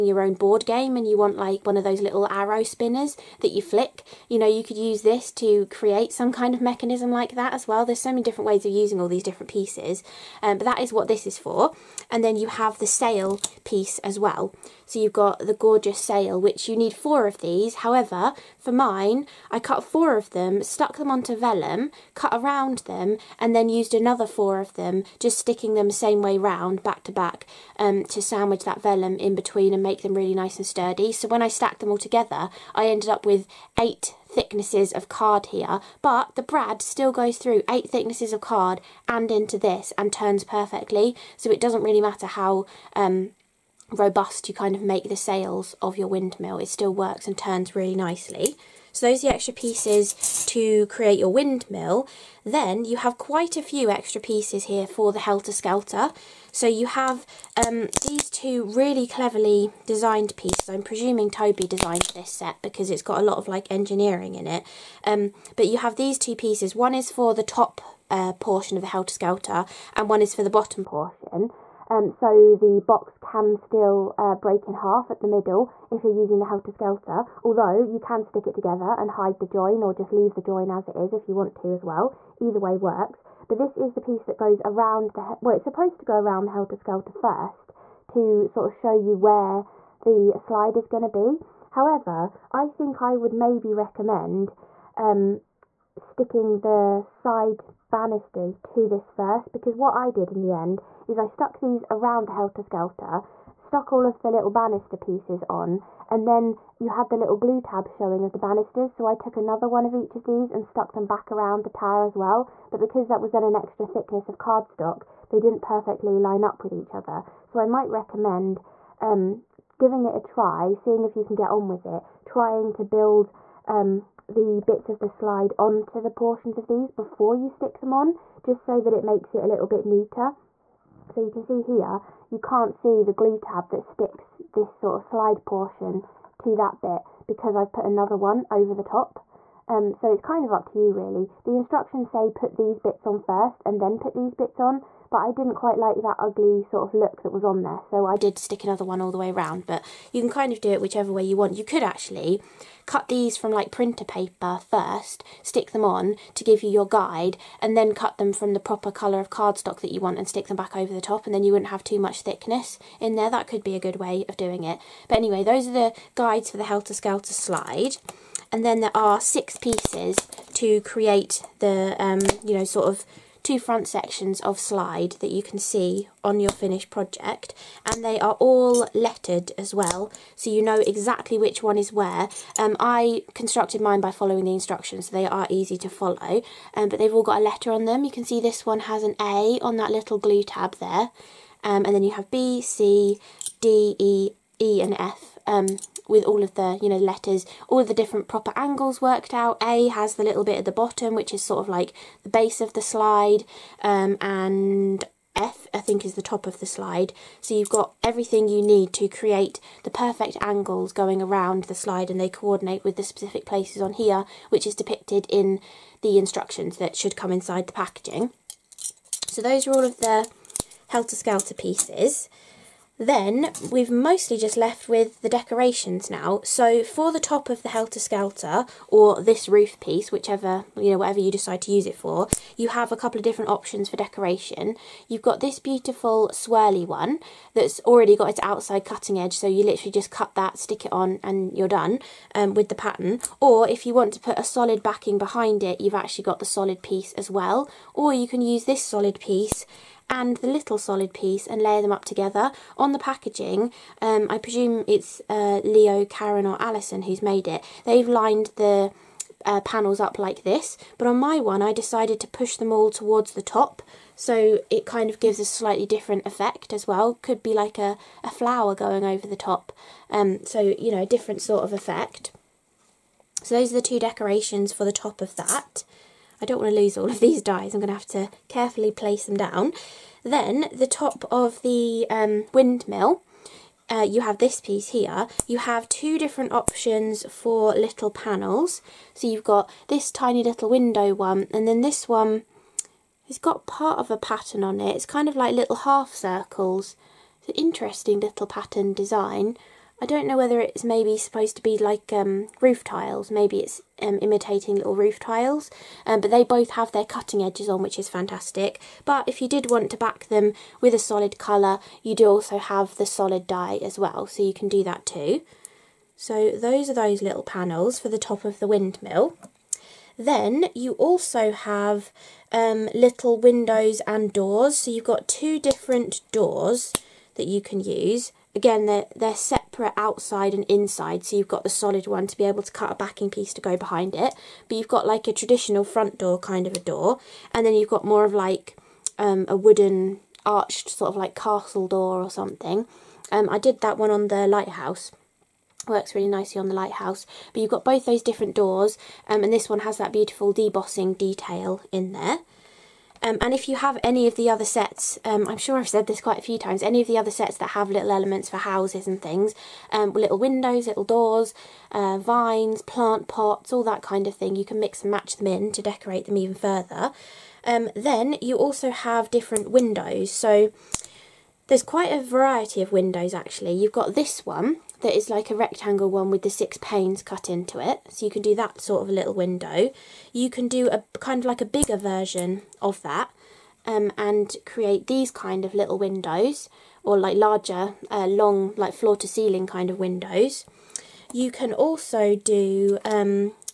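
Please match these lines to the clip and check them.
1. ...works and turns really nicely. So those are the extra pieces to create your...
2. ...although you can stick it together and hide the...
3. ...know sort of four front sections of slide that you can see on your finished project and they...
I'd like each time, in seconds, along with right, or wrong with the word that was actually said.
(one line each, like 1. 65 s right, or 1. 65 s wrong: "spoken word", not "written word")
1. 46 s right
2. 77 s right
3. 172 s wrong: "two", not "four".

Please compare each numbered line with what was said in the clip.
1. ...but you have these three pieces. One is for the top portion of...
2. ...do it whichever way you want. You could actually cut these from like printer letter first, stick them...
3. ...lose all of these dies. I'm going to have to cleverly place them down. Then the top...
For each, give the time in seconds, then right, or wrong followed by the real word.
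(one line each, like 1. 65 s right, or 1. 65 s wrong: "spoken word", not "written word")
1. 65 s wrong: "two", not "three"
2. 150 s wrong: "paper", not "letter"
3. 276 s wrong: "carefully", not "cleverly".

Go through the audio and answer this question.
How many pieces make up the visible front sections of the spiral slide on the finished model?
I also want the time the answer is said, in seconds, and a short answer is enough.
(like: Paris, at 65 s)
6, at 169 s.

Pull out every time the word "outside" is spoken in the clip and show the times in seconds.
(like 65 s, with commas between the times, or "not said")
238 s, 329 s.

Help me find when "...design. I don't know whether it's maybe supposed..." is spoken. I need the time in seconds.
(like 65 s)
298 s.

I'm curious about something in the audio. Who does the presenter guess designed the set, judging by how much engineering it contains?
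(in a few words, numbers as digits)
Toby.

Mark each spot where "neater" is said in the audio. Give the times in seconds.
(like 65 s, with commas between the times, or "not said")
129 s.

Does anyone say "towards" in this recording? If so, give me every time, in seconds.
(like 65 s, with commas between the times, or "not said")
262 s.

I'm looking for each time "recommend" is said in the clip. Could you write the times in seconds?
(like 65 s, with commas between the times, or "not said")
93 s, 117 s.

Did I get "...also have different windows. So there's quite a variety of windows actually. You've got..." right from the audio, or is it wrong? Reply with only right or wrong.
right.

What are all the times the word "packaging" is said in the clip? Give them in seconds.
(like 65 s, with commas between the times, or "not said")
217 s, 252 s.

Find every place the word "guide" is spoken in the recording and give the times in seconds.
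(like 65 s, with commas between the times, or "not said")
156 s, 166 s.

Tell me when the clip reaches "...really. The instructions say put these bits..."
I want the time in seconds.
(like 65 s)
140 s.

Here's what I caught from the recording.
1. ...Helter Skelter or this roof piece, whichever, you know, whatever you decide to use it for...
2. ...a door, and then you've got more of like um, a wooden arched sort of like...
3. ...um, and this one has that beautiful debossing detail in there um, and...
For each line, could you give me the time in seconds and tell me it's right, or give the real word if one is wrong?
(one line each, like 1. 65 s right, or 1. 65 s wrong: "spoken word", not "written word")
1. 227 s right
2. 336 s right
3. 349 s right.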